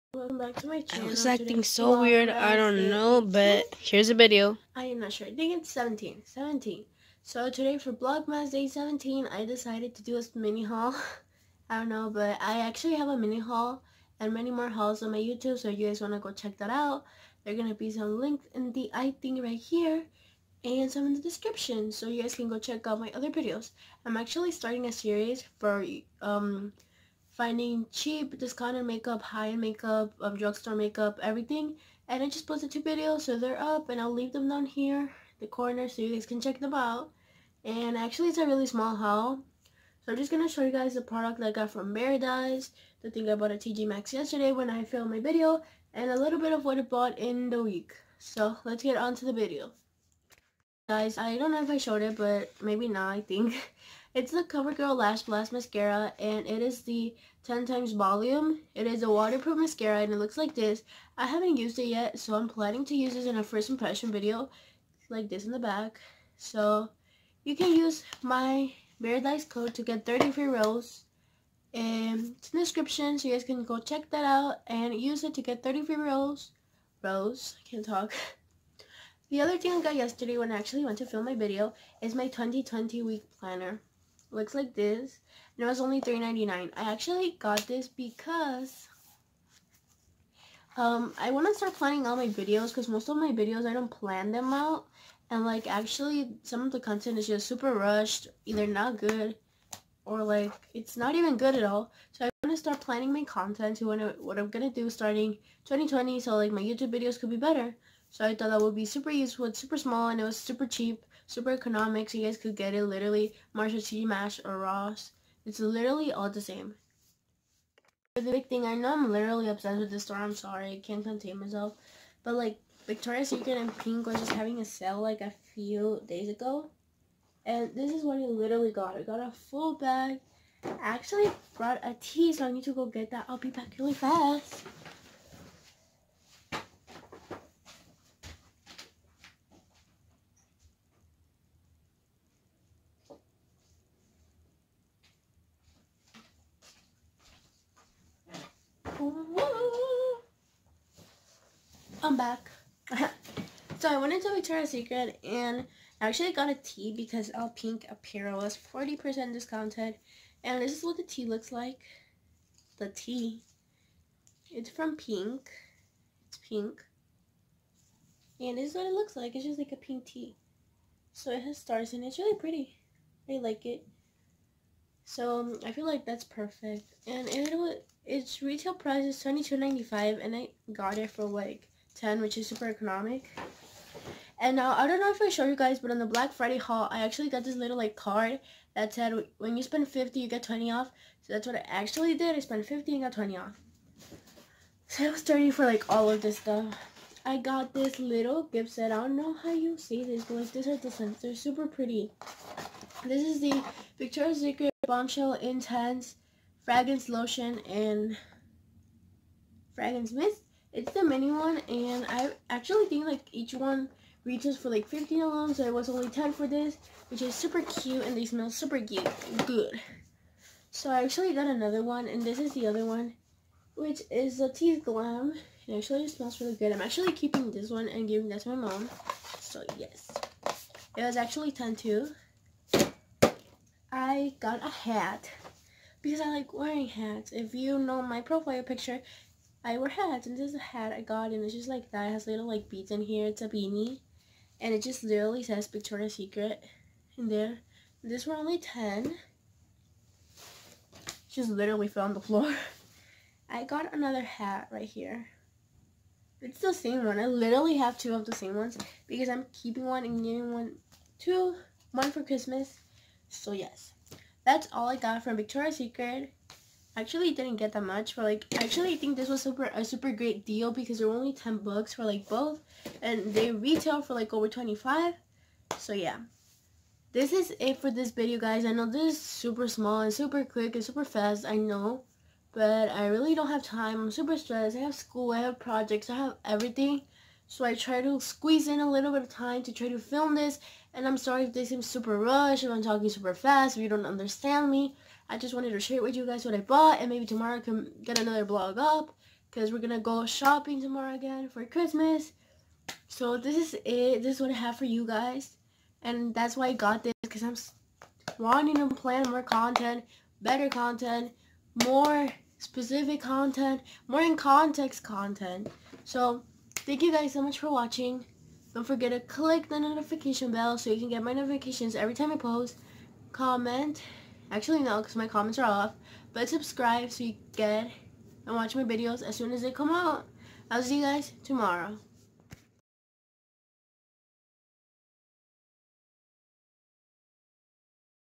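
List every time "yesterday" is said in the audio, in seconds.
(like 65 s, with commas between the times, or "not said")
44 s, 79 s.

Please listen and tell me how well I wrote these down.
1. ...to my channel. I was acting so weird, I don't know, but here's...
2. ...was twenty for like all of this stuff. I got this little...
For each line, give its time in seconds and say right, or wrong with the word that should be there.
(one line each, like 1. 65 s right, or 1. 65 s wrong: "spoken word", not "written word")
1. 0 s right
2. 195 s wrong: "thirty", not "twenty".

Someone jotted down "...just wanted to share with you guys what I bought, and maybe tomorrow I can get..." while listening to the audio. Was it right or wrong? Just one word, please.
right.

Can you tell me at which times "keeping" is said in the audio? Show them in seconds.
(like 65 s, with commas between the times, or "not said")
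227 s, 259 s.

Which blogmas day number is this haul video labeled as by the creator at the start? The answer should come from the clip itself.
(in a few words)
17.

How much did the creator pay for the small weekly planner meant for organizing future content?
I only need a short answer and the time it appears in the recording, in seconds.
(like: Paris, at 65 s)
$3.99, at 86 s.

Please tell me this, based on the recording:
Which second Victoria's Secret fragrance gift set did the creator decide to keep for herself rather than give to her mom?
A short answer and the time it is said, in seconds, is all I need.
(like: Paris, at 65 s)
Tease Glam, at 224 s.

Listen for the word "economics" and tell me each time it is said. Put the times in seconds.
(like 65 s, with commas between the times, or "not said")
111 s, 182 s.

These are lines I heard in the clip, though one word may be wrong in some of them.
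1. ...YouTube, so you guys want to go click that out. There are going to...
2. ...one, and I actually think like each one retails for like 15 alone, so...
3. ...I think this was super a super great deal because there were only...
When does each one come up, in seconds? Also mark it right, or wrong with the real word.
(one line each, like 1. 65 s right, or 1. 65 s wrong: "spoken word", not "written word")
1. 15 s wrong: "check", not "click"
2. 211 s right
3. 268 s right.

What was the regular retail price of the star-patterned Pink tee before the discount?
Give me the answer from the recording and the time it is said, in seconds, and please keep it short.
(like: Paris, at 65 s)
$22.95, at 179 s.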